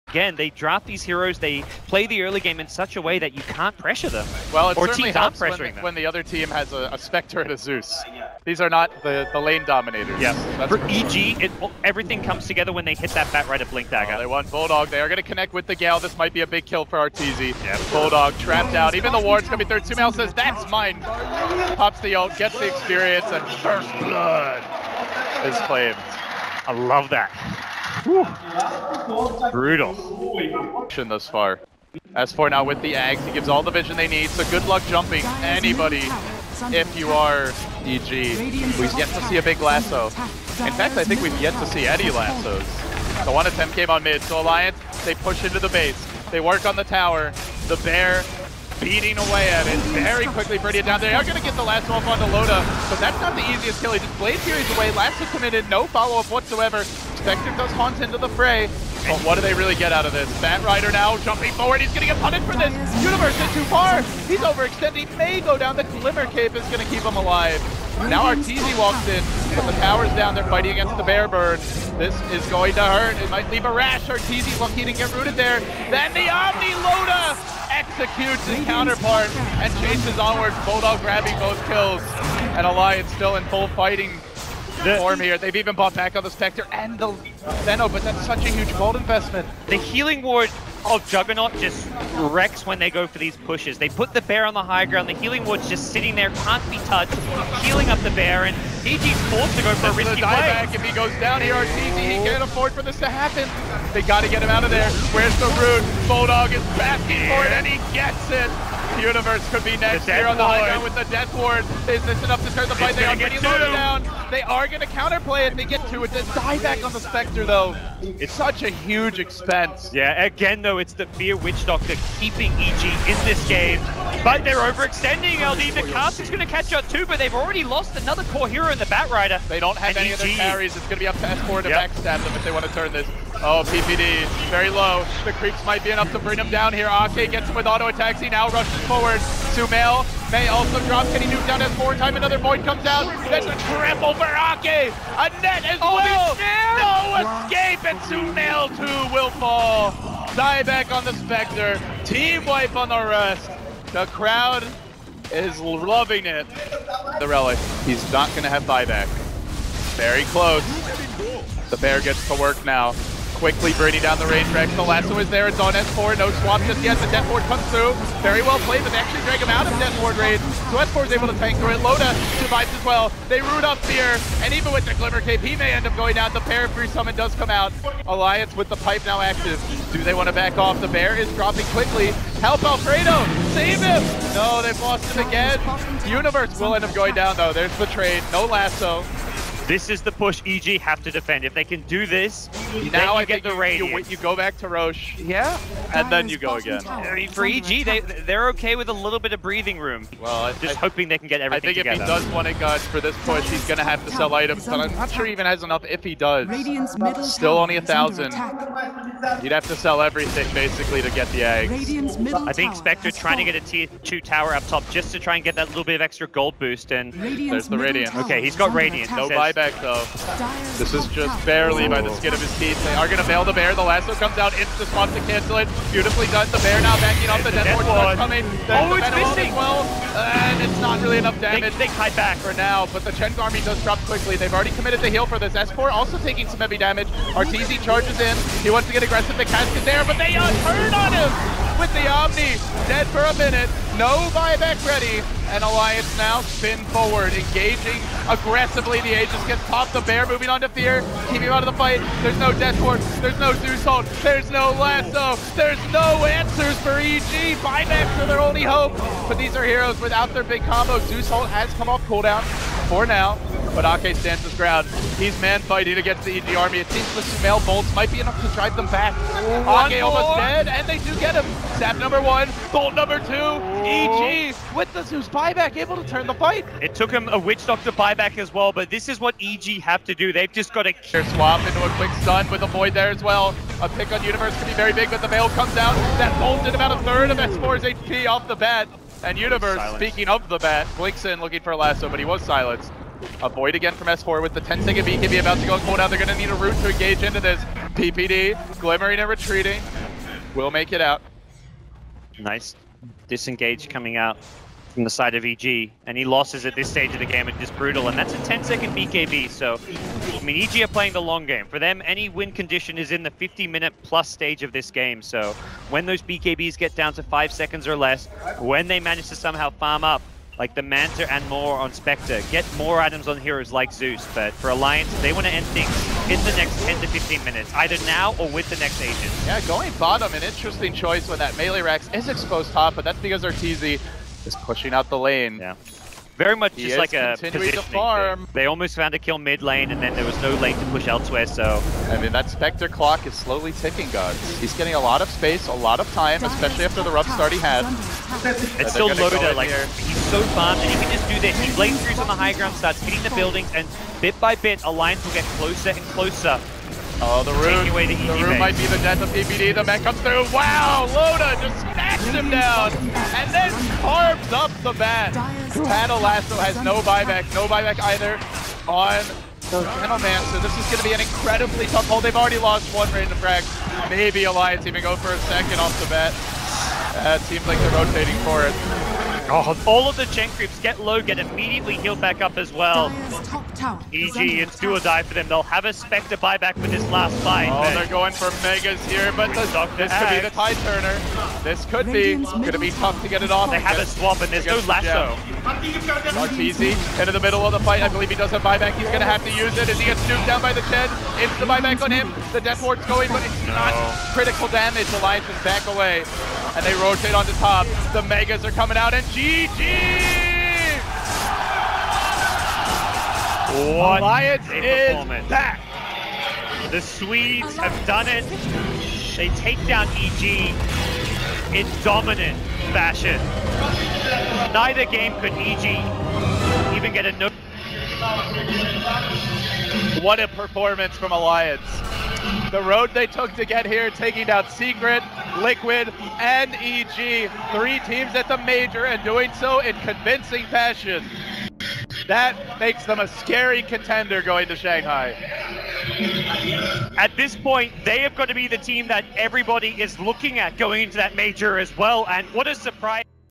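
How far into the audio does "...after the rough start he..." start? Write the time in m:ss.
5:46.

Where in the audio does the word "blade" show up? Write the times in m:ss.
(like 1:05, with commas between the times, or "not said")
0:54, 5:51.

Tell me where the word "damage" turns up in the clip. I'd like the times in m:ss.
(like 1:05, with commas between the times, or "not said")
3:51, 3:56, 6:44.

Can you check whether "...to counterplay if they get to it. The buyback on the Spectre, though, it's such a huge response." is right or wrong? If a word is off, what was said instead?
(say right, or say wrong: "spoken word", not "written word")
wrong: "expense", not "response".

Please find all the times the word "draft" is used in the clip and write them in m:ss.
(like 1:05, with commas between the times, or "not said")
0:00.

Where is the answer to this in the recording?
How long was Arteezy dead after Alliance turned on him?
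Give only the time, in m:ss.
4:02.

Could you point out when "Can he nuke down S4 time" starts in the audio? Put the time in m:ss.
2:21.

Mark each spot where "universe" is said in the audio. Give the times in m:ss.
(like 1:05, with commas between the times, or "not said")
1:03, 1:48, 3:06, 4:44, 4:49.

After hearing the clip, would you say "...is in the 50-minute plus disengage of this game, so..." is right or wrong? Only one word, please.
wrong.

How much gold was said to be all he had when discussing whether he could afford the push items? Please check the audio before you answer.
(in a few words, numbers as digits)
1000.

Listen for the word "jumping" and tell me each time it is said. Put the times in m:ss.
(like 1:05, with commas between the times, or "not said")
0:34, 1:01.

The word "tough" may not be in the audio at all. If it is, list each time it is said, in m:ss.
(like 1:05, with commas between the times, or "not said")
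6:11, 6:32.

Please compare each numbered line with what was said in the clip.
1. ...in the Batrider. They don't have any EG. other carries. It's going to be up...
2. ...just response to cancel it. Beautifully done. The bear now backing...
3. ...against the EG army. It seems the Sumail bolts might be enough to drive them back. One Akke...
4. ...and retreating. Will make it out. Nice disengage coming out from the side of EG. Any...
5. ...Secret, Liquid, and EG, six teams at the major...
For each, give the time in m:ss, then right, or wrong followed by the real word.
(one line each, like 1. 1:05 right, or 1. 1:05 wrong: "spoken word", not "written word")
1. 2:08 right
2. 3:44 right
3. 4:25 right
4. 4:59 right
5. 7:14 wrong: "three", not "six".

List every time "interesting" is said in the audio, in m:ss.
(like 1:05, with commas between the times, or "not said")
5:30.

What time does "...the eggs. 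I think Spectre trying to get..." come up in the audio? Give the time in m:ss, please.
3:31.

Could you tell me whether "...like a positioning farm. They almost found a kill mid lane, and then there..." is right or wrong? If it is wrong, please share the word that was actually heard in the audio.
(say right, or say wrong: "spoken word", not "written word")
right.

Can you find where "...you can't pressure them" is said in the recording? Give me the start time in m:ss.
0:03.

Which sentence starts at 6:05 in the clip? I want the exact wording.
Paddle Lasso has no buyback, no buyback either on Genoman.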